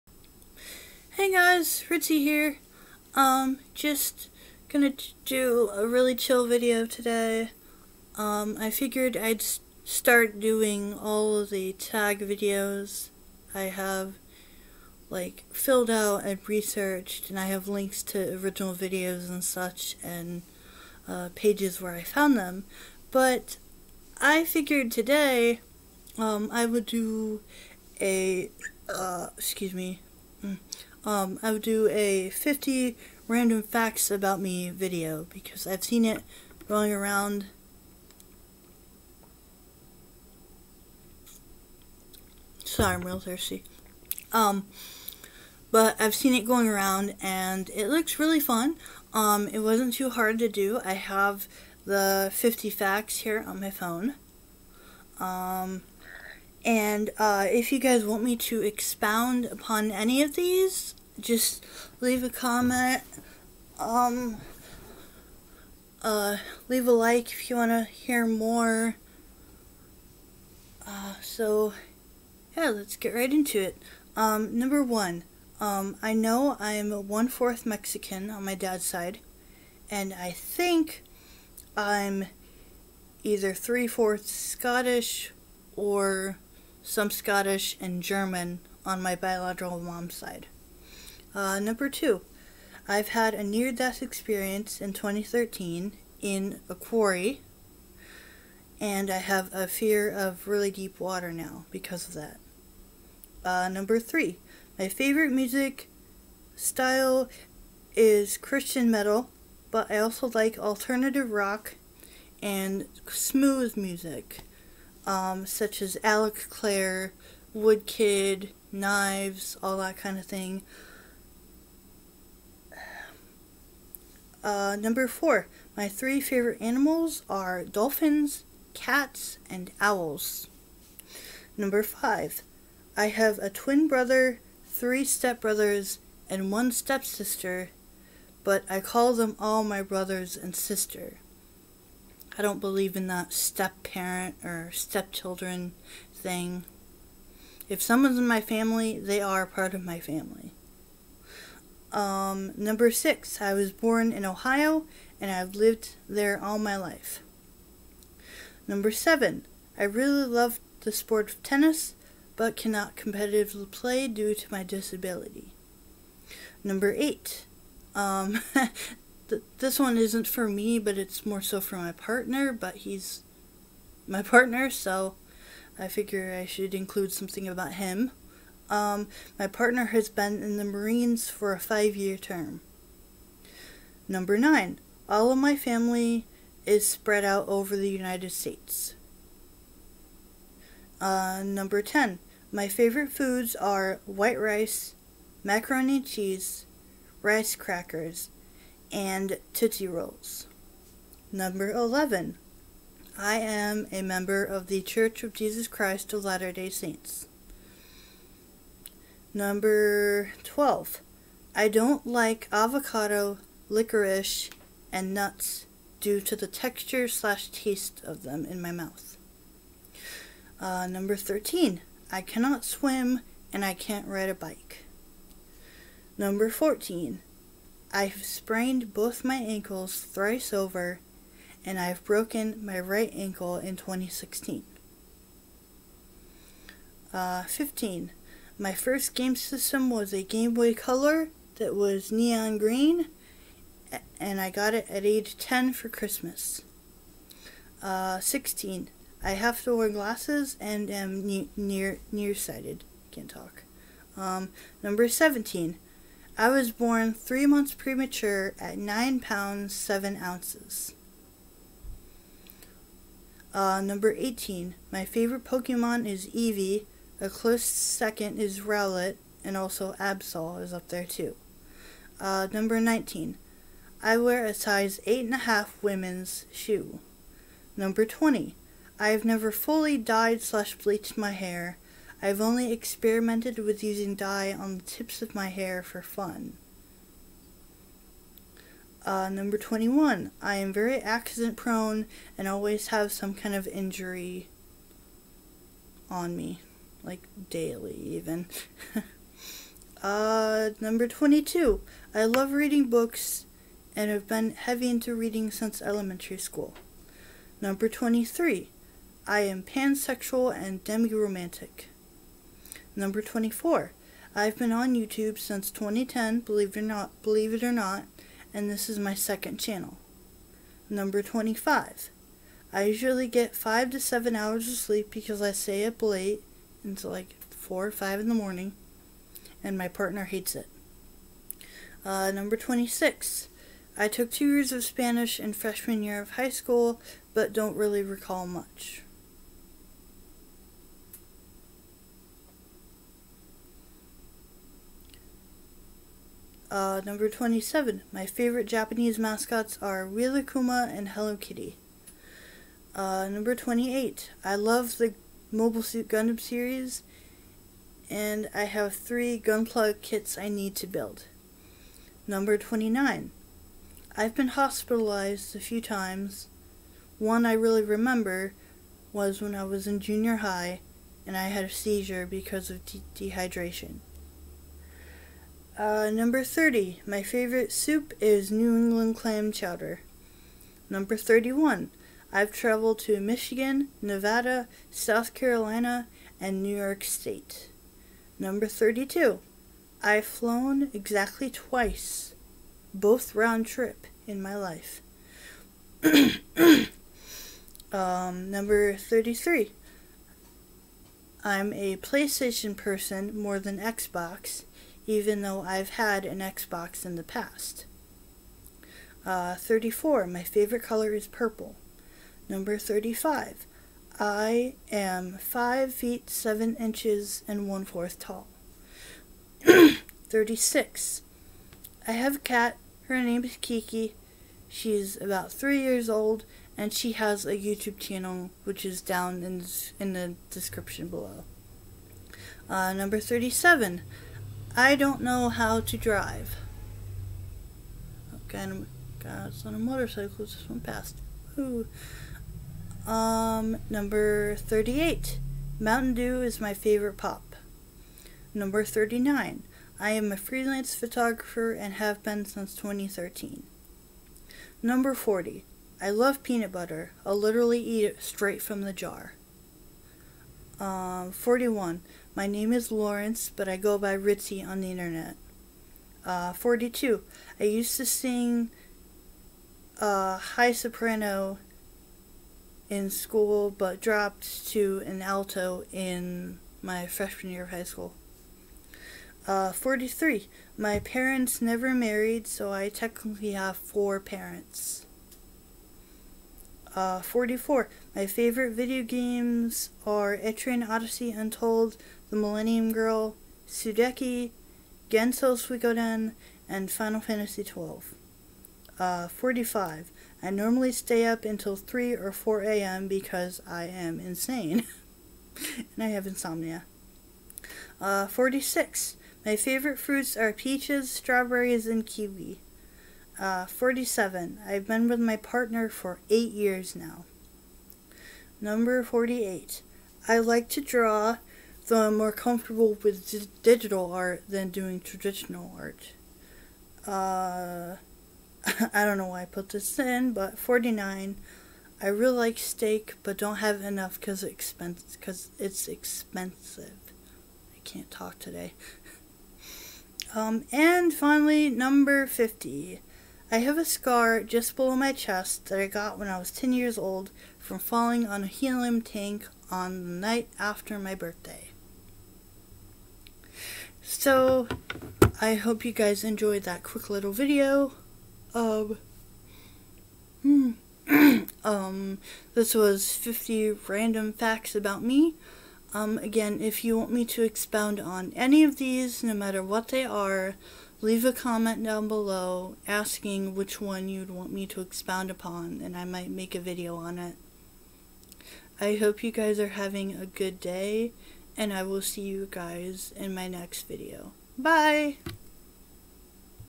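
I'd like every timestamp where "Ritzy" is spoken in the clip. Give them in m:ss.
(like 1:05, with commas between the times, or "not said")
0:01, 7:44.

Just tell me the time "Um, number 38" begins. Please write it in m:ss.
7:23.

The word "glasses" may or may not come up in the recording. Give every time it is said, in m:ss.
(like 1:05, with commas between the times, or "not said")
4:09.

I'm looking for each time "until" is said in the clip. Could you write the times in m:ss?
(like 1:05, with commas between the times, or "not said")
5:26, 8:21.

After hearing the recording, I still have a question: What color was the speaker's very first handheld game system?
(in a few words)
neon green.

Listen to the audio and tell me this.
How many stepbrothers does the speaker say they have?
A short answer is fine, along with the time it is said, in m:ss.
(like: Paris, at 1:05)
3, at 2:14.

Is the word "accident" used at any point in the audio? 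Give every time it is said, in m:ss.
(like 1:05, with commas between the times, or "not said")
4:50.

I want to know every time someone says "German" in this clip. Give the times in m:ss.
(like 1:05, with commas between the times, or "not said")
1:28.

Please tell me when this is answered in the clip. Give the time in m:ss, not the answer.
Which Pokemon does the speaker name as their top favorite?
4:26.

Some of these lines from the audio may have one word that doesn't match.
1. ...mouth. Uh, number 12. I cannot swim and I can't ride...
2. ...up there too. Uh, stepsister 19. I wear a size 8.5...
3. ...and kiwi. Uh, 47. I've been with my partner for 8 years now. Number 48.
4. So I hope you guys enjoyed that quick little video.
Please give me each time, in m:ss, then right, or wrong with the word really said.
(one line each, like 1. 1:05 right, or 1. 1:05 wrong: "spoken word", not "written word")
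1. 3:38 wrong: "13", not "12"
2. 4:30 wrong: "number", not "stepsister"
3. 8:31 right
4. 9:14 right.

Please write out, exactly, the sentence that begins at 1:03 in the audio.
Um, uh, leave a like if you want to hear more.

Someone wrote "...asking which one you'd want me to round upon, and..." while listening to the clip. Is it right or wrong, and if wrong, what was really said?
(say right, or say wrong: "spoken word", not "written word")
wrong: "expound", not "round".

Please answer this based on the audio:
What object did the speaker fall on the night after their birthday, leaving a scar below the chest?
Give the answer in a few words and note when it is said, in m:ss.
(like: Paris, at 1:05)
helium tank, at 9:08.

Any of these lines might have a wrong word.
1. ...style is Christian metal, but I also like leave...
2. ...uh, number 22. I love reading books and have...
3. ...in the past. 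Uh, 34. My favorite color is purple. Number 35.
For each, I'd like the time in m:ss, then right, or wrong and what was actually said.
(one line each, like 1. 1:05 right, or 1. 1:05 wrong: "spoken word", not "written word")
1. 1:46 wrong: "alternative", not "leave"
2. 5:00 right
3. 6:47 right.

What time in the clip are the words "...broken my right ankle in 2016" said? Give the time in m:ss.
3:52.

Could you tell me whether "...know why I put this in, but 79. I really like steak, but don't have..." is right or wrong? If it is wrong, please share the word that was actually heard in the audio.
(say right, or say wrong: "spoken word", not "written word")
wrong: "49", not "79".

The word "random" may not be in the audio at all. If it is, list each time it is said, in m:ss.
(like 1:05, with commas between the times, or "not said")
0:33, 9:23.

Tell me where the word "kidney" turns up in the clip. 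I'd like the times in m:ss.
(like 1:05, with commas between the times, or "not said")
not said.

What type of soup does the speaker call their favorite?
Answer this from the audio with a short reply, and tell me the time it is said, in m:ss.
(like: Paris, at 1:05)
New England clam chowder, at 6:18.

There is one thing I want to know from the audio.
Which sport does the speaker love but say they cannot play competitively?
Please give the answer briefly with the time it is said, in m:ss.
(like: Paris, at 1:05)
tennis, at 2:41.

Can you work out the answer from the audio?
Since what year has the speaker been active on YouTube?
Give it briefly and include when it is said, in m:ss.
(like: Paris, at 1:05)
2010, at 5:15.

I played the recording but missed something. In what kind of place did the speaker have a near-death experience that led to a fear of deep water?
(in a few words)
quarry.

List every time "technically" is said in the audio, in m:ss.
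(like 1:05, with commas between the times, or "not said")
8:02.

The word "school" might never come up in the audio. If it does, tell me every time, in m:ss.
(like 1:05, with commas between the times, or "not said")
5:06, 5:36, 7:53, 7:57.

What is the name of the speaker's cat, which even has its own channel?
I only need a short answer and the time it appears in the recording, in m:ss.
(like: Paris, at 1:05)
Kiki, at 7:03.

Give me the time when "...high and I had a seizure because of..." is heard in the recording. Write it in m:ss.
6:10.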